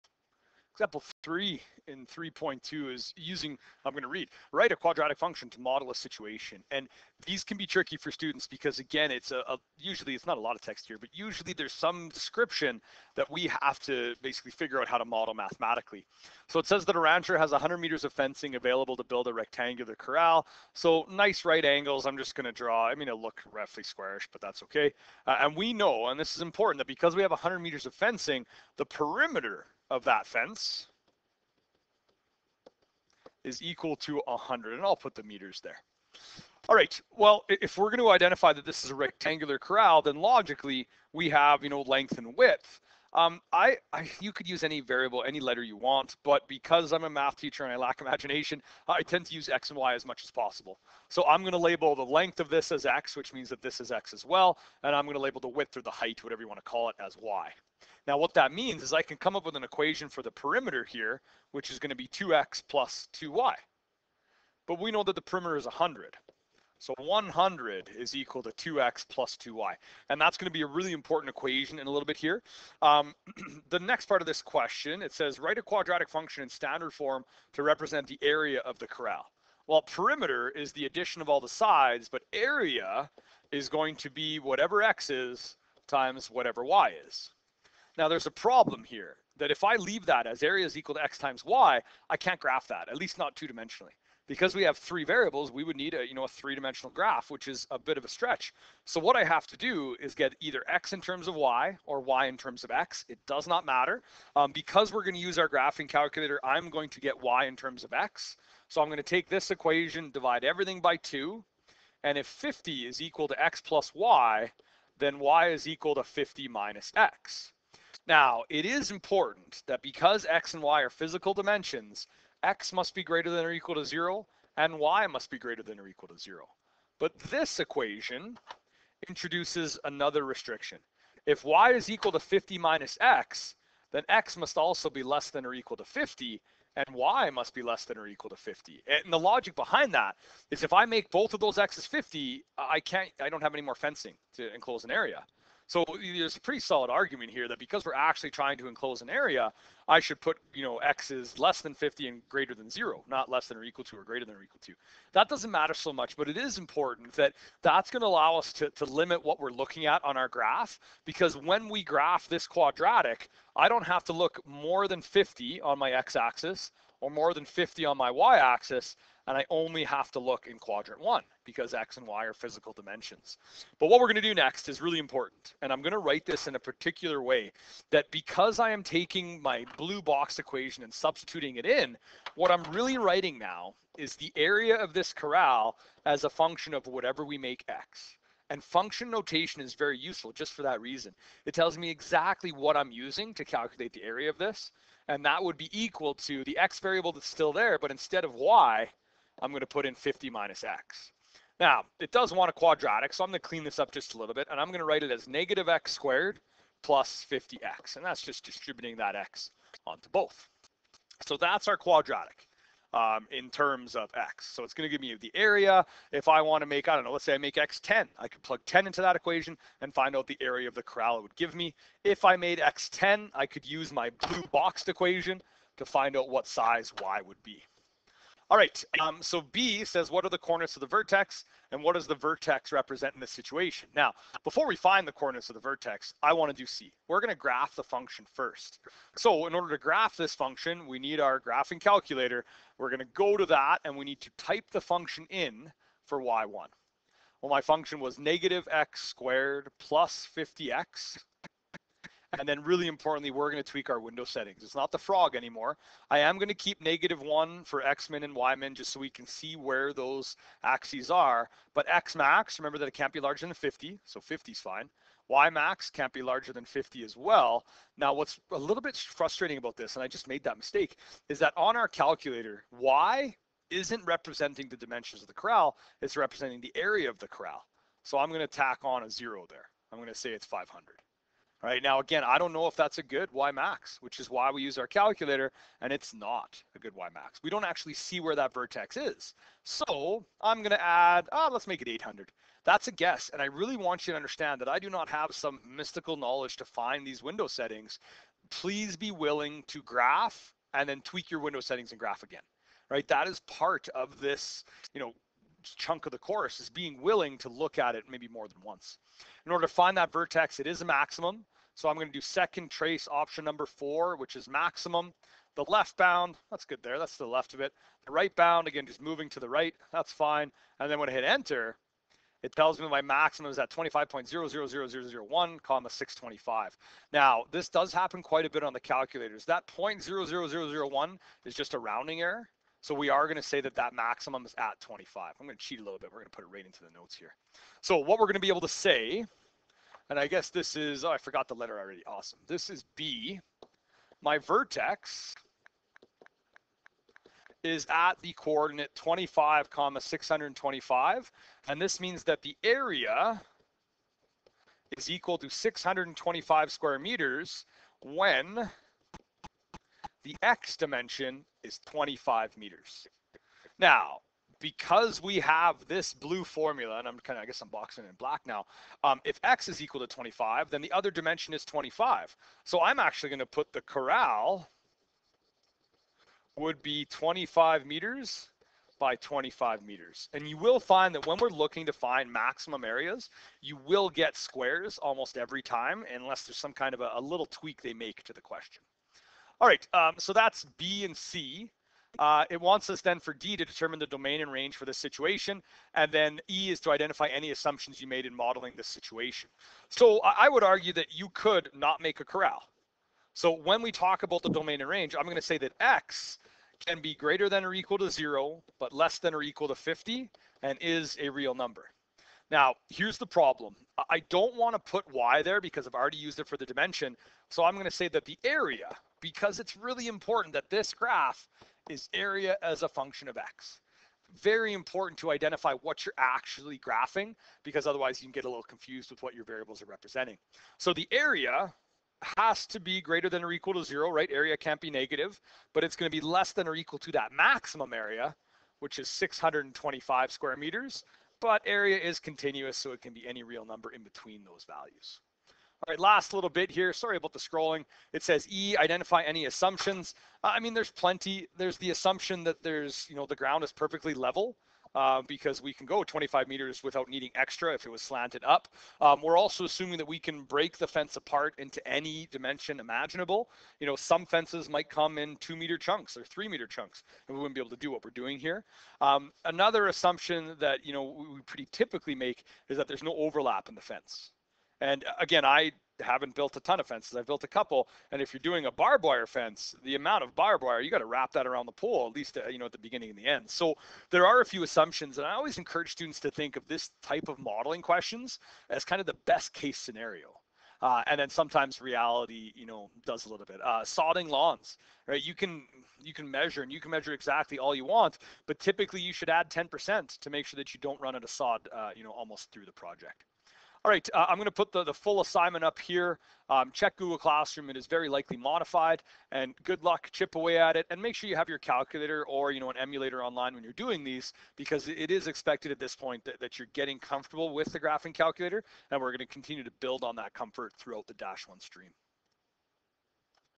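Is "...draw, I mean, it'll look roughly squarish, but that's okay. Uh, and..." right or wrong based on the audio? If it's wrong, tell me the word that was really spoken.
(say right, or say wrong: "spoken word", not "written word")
right.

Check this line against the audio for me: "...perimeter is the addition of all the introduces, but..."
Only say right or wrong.
wrong.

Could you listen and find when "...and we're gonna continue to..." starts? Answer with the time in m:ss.
8:38.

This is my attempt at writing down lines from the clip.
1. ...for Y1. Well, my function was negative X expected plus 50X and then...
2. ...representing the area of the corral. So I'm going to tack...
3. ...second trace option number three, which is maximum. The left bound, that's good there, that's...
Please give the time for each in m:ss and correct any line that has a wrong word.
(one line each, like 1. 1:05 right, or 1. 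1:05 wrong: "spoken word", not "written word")
1. 4:06 wrong: "squared", not "expected"
2. 4:36 right
3. 5:12 wrong: "four", not "three".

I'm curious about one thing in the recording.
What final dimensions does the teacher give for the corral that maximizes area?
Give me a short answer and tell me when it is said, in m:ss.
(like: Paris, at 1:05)
25 meters by 25 meters, at 6:17.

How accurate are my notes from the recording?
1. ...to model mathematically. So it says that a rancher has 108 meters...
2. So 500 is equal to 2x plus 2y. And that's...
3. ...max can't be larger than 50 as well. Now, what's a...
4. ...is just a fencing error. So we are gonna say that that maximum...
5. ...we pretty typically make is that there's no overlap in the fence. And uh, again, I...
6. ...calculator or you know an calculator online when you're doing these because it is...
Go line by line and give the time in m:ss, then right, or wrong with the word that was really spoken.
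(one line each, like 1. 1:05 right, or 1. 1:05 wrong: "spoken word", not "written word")
1. 0:14 wrong: "100", not "108"
2. 1:06 wrong: "100", not "500"
3. 4:25 right
4. 5:31 wrong: "rounding", not "fencing"
5. 7:51 right
6. 8:31 wrong: "emulator", not "calculator".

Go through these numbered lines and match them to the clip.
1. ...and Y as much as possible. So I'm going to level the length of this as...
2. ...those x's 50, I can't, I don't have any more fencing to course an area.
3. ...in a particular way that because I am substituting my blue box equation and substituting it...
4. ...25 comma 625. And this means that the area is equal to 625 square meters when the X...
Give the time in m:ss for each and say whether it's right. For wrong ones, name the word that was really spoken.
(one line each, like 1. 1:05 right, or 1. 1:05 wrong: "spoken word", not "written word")
1. 0:49 wrong: "label", not "level"
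2. 2:21 wrong: "enclose", not "course"
3. 2:56 wrong: "taking", not "substituting"
4. 5:48 right.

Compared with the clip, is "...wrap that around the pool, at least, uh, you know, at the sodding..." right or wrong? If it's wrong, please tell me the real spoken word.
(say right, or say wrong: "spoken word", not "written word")
wrong: "beginning", not "sodding".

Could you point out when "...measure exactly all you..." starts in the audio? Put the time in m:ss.
8:16.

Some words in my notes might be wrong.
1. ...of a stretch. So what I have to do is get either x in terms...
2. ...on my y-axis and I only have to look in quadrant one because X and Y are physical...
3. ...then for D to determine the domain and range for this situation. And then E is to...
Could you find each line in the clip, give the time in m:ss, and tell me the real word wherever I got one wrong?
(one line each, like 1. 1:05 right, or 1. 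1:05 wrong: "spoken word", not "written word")
1. 1:37 right
2. 2:47 right
3. 6:33 right.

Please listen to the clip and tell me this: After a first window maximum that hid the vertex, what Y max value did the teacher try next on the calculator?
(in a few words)
800.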